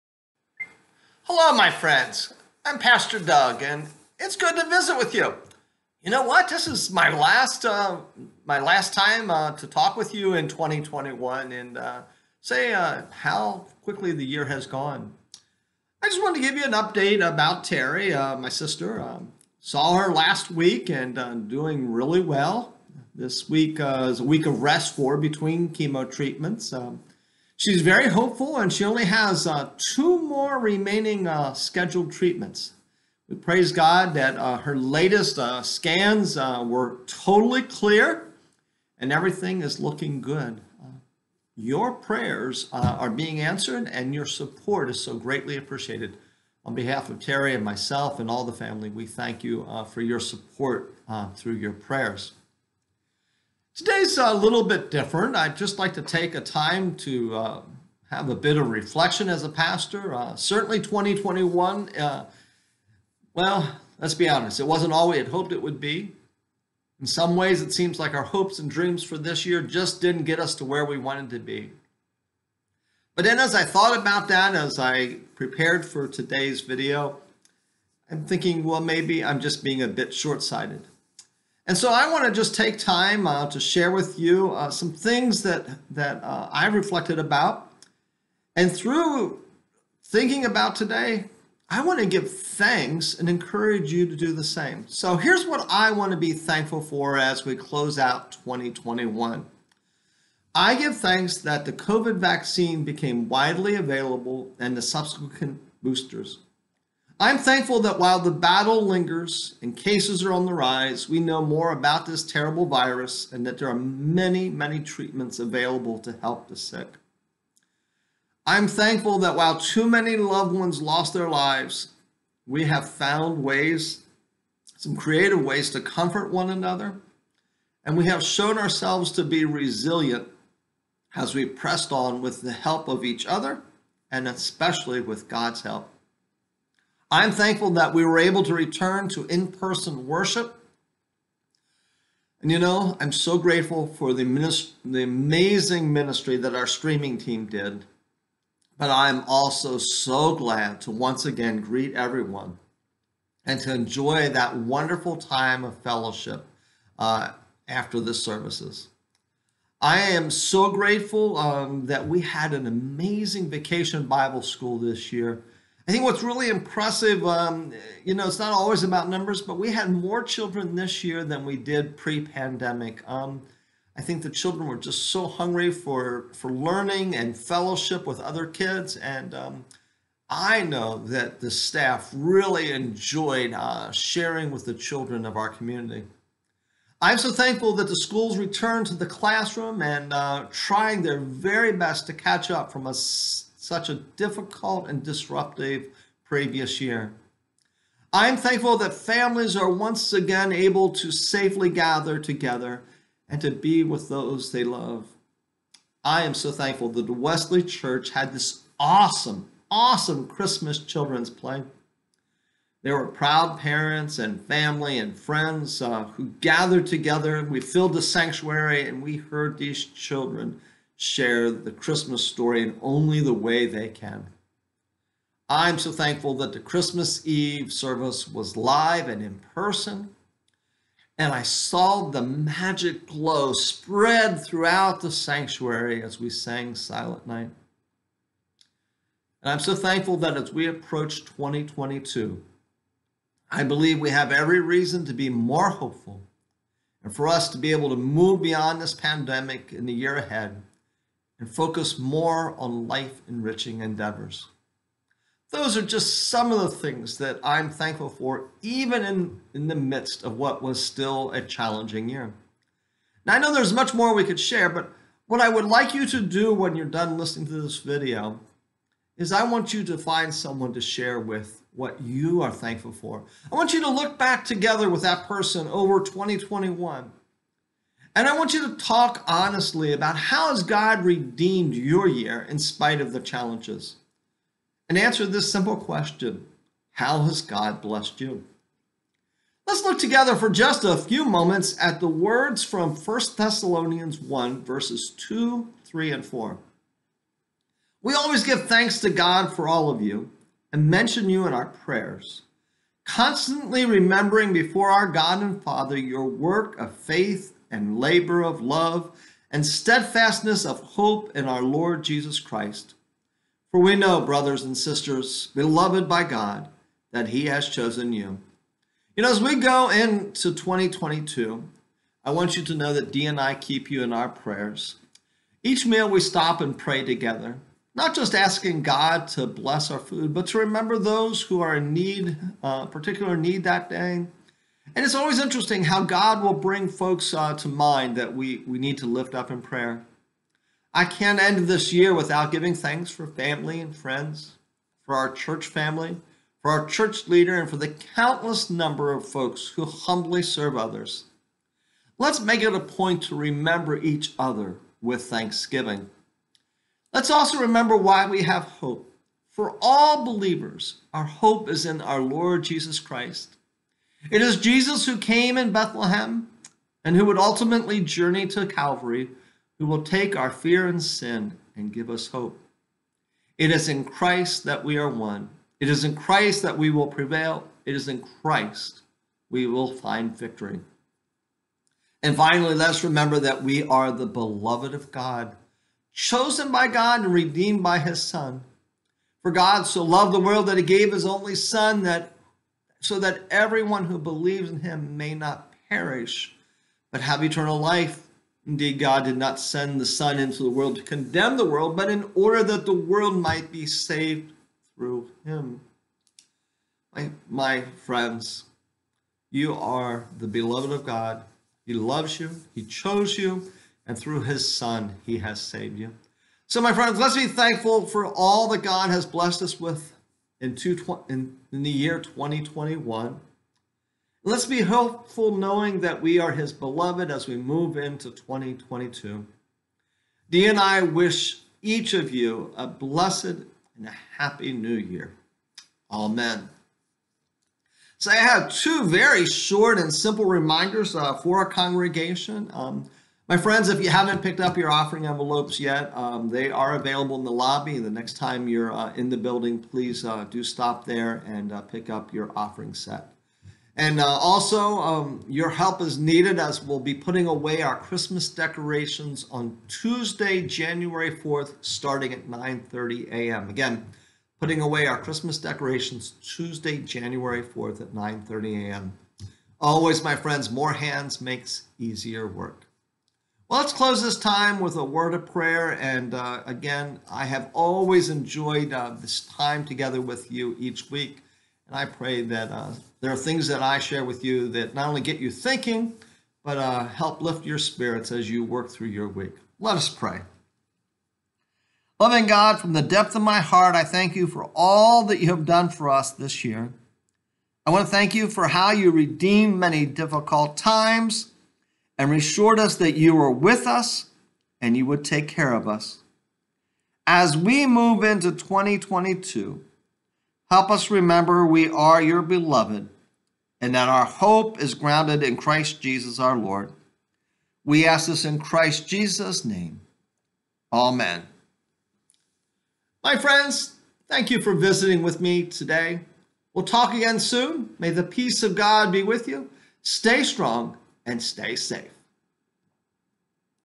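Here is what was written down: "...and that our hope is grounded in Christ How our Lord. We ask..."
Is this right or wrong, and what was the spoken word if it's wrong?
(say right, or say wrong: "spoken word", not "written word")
wrong: "Jesus", not "How".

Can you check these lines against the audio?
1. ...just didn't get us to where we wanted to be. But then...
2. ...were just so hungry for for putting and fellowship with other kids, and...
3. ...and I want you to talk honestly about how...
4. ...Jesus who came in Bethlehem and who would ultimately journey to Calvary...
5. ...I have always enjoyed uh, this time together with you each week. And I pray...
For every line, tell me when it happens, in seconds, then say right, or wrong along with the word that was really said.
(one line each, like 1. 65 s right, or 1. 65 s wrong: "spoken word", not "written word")
1. 69 s right
2. 174 s wrong: "learning", not "putting"
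3. 278 s right
4. 364 s right
5. 477 s right.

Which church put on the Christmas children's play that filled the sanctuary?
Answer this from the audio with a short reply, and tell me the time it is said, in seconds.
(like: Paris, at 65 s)
Wesley Church, at 207 s.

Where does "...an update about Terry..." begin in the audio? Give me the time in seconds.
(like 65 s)
16 s.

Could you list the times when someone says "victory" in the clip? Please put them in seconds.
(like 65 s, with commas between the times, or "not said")
380 s.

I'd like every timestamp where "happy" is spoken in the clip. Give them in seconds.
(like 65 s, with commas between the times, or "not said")
434 s.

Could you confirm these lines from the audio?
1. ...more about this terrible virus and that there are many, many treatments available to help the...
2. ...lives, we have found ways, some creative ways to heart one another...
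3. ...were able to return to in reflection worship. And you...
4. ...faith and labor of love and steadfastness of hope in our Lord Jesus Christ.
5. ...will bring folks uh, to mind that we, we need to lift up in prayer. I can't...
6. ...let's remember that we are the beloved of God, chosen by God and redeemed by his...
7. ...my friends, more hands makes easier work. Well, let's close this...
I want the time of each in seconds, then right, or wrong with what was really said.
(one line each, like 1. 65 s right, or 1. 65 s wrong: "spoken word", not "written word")
1. 111 s right
2. 121 s wrong: "comfort", not "heart"
3. 138 s wrong: "person", not "reflection"
4. 306 s right
5. 336 s right
6. 382 s right
7. 470 s right.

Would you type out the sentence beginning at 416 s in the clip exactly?
So, my friends, let's be thankful for all that God has blessed us with in, two, in, in the year 2021.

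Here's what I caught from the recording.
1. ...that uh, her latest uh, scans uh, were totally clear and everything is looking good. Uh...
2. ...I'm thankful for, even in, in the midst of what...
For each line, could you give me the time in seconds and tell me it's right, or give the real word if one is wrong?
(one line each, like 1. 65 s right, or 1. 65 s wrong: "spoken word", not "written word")
1. 34 s right
2. 257 s right.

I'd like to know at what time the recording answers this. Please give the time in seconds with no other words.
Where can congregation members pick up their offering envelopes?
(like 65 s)
447 s.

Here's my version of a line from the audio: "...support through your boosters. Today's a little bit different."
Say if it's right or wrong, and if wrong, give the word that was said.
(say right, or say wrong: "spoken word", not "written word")
wrong: "prayers", not "boosters".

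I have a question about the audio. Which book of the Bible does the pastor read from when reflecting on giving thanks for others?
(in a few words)
1 Thessalonians.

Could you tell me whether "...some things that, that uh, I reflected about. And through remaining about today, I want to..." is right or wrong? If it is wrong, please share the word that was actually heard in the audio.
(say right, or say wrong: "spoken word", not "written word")
wrong: "thinking", not "remaining".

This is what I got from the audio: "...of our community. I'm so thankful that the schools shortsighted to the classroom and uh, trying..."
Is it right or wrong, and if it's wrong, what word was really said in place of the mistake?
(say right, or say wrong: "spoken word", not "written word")
wrong: "returned", not "shortsighted".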